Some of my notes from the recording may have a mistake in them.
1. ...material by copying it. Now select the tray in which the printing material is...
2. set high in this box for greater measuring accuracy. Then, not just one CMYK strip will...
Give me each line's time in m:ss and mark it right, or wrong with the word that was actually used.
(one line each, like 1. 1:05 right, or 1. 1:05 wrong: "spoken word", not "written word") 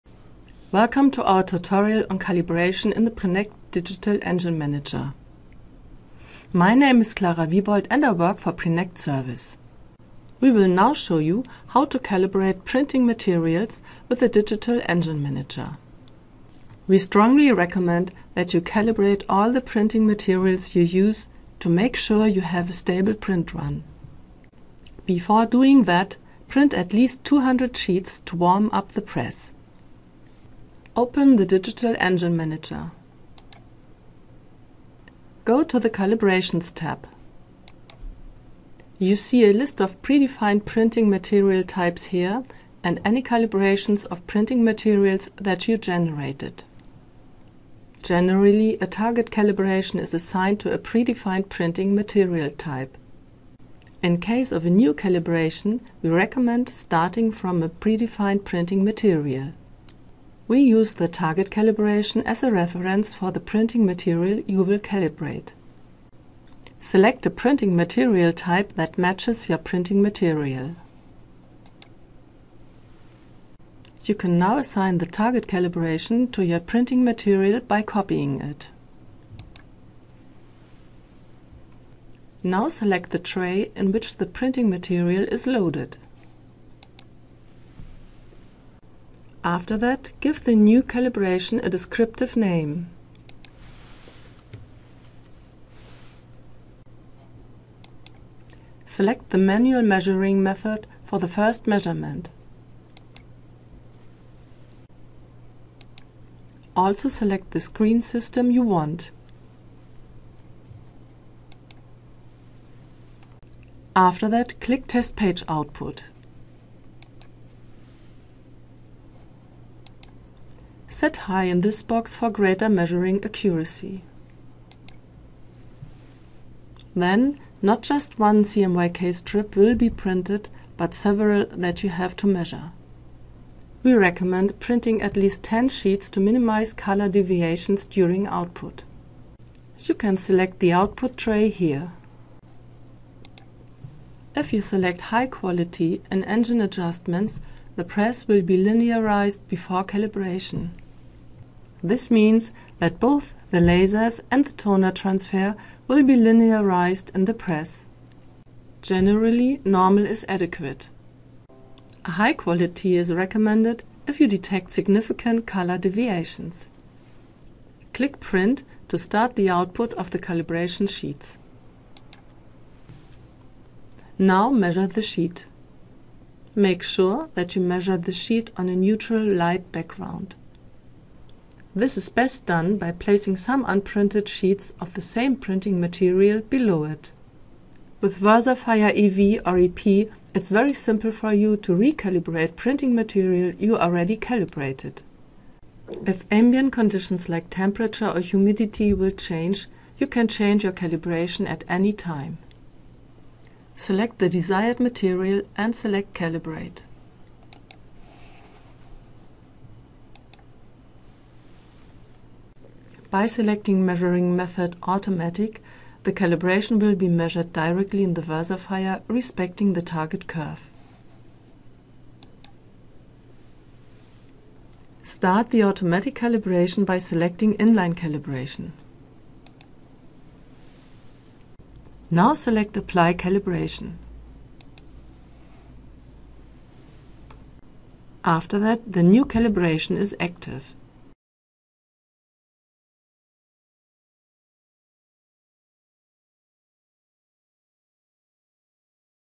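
1. 1:17 right
2. 2:01 right.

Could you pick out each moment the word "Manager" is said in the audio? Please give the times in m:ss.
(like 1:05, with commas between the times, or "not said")
0:04, 0:15, 0:32.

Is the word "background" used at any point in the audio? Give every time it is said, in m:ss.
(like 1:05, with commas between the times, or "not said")
2:59.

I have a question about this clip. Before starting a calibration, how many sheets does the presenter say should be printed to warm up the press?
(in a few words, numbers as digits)
200.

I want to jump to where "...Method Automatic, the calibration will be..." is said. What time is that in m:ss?
3:34.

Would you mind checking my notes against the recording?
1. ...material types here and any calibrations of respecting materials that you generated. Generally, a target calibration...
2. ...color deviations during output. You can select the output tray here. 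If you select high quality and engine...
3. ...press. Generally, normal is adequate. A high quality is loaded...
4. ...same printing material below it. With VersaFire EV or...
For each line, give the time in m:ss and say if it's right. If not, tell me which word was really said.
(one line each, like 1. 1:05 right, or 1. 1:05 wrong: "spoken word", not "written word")
1. 0:41 wrong: "printing", not "respecting"
2. 2:16 right
3. 2:37 wrong: "recommended", not "loaded"
4. 3:04 right.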